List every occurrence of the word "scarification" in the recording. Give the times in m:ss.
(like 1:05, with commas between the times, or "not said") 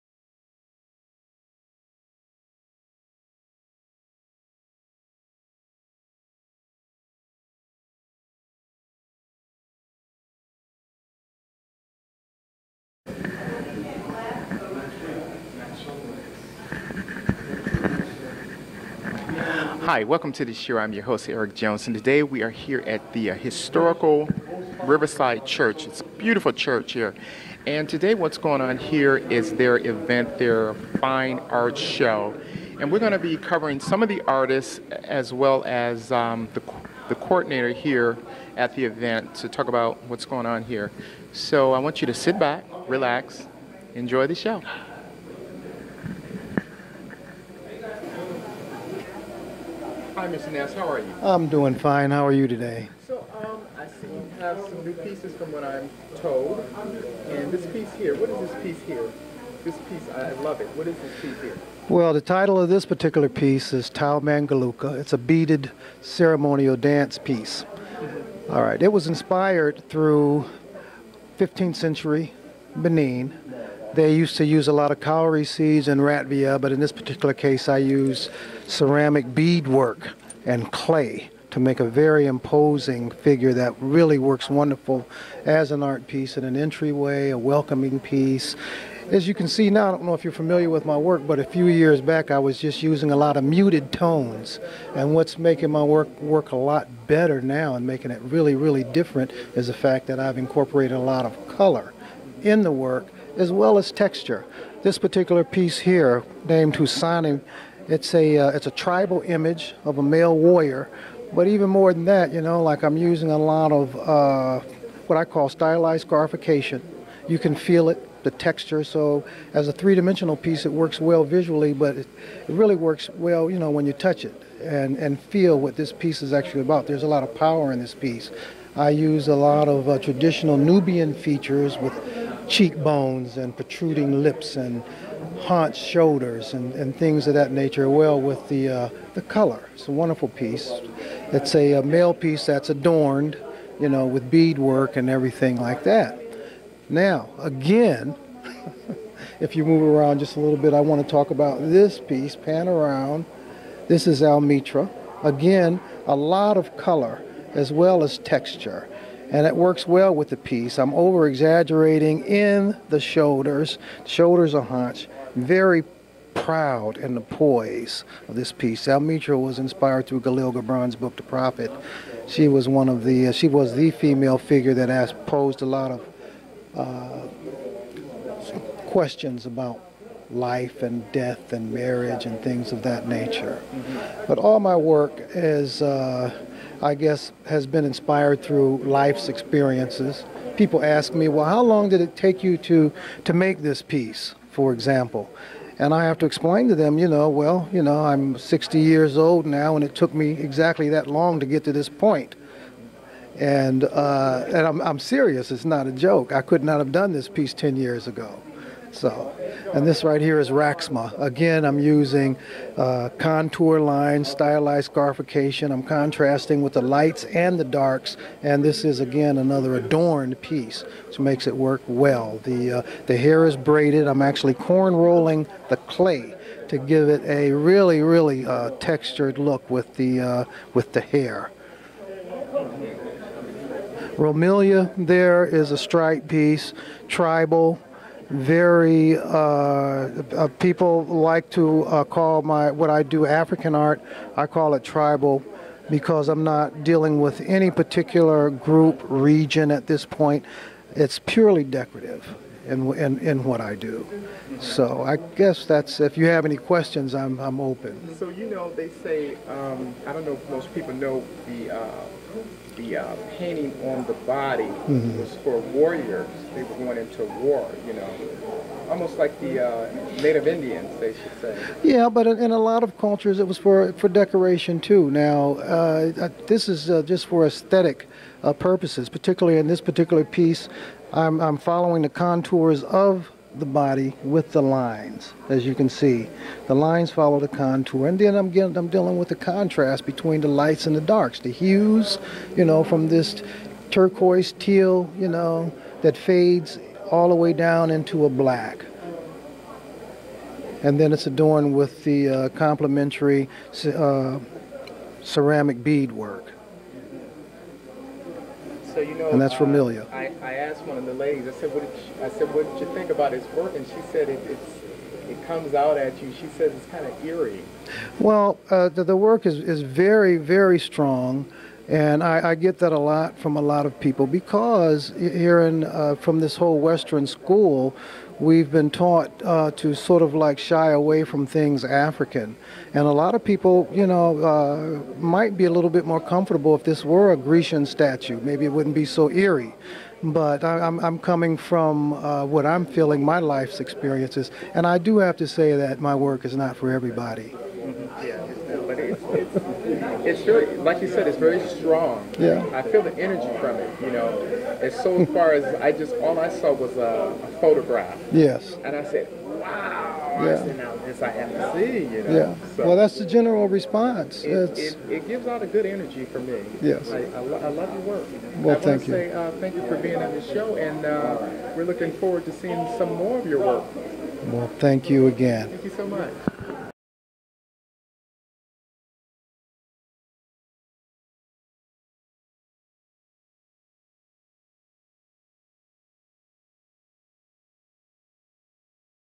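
1:56, 3:34.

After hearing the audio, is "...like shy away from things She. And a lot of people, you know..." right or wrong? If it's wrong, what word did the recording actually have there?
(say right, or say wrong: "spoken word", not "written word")
wrong: "African", not "She".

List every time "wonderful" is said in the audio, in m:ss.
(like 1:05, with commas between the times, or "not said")
1:24, 2:19.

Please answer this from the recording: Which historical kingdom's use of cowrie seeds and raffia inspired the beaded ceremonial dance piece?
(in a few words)
Benin.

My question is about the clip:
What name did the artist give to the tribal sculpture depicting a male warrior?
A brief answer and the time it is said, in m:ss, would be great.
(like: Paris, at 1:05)
Husani, at 1:46.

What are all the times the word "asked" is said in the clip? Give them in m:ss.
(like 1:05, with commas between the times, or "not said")
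2:54, 5:10.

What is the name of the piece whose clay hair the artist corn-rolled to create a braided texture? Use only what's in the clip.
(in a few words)
Raxma.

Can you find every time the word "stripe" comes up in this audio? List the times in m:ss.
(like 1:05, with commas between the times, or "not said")
3:55.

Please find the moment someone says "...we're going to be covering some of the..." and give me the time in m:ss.
0:32.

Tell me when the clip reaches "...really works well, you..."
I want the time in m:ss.
2:02.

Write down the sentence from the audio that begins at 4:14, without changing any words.
So I guess that's if you have any questions, I'm I'm open.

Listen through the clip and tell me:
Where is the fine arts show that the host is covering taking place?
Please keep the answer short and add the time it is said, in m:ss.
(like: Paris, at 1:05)
Riverside Church, at 0:24.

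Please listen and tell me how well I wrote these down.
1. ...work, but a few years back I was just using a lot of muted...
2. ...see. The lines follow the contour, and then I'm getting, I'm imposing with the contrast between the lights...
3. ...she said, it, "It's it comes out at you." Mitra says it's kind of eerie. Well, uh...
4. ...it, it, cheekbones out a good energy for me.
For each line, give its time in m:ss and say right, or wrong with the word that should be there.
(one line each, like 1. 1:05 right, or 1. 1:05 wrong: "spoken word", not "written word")
1. 1:30 right
2. 4:45 wrong: "dealing", not "imposing"
3. 5:13 wrong: "She", not "Mitra"
4. 6:04 wrong: "gives", not "cheekbones".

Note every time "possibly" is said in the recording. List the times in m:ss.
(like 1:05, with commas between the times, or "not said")
not said.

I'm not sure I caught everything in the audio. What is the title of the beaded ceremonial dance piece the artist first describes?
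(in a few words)
Tau Mangaluka.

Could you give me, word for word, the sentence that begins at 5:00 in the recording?
And then it's adorned with the uh, complementary uh, ceramic beadwork.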